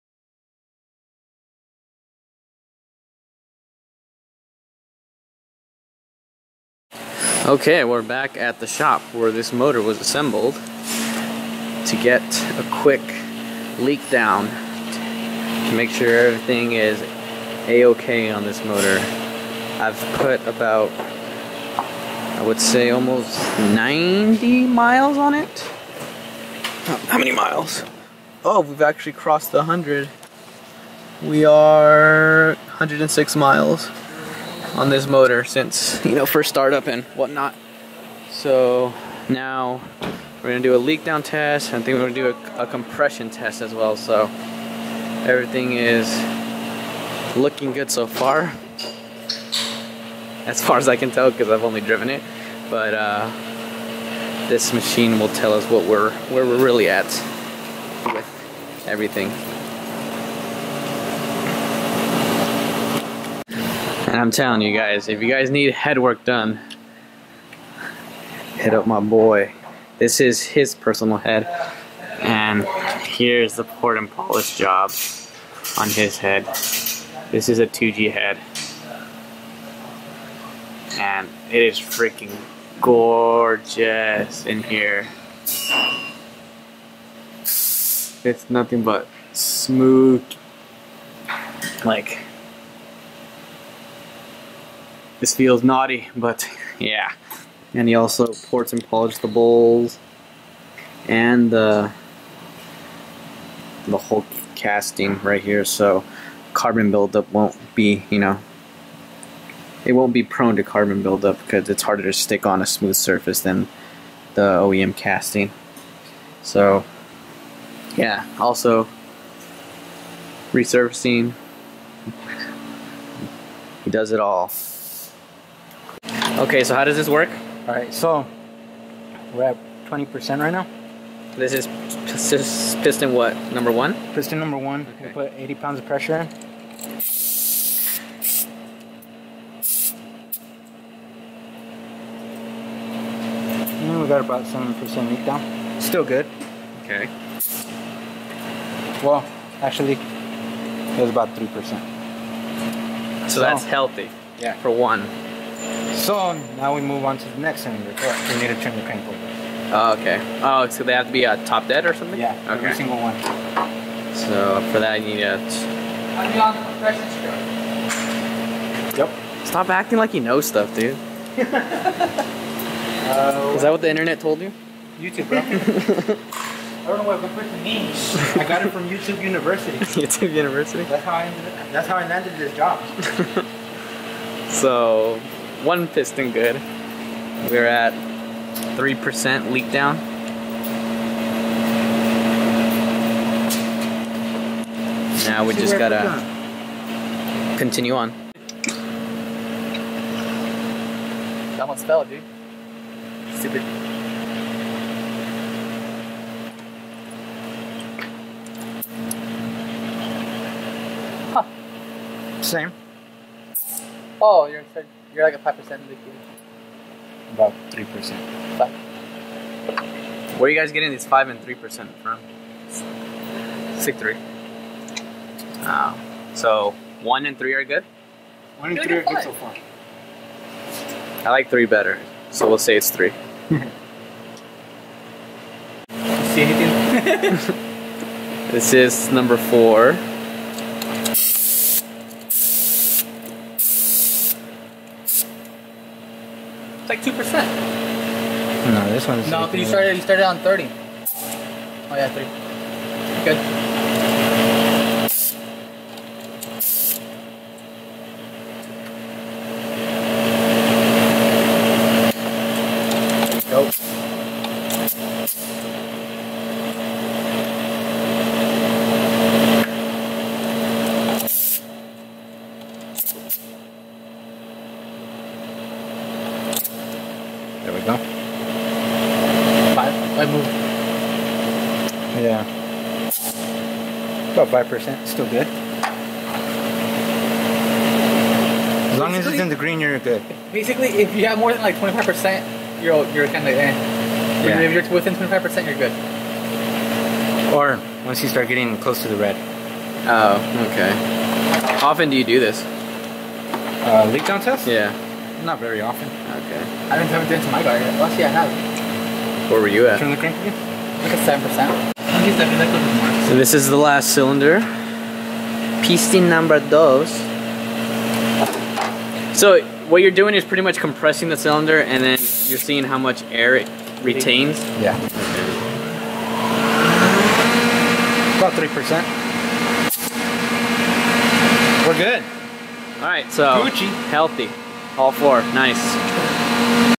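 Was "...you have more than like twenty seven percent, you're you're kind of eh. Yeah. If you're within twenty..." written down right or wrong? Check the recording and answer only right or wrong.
wrong.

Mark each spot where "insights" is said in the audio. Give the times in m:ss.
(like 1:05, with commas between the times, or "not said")
not said.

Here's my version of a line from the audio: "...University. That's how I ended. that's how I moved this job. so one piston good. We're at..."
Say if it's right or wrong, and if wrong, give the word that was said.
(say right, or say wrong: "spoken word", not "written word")
wrong: "landed", not "moved".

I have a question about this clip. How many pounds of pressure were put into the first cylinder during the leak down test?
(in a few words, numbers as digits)
80.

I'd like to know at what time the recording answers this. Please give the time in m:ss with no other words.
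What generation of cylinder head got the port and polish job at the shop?
1:17.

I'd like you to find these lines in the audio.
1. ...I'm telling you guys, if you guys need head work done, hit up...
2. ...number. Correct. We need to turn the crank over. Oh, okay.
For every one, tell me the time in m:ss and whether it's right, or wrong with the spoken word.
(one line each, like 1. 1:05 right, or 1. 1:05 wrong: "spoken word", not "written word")
1. 1:04 right
2. 2:37 wrong: "cylinder", not "number".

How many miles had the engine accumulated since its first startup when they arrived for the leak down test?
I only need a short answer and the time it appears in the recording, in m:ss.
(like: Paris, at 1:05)
106, at 0:32.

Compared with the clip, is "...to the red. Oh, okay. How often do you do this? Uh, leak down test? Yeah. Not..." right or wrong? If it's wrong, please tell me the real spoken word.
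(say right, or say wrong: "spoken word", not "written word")
right.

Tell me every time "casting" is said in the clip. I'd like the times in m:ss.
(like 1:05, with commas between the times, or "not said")
1:44, 1:54.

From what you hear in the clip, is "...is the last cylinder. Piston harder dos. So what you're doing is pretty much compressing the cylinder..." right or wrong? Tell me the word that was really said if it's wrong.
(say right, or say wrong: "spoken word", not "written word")
wrong: "number", not "harder".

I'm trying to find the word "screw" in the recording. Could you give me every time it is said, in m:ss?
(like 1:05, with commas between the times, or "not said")
2:47.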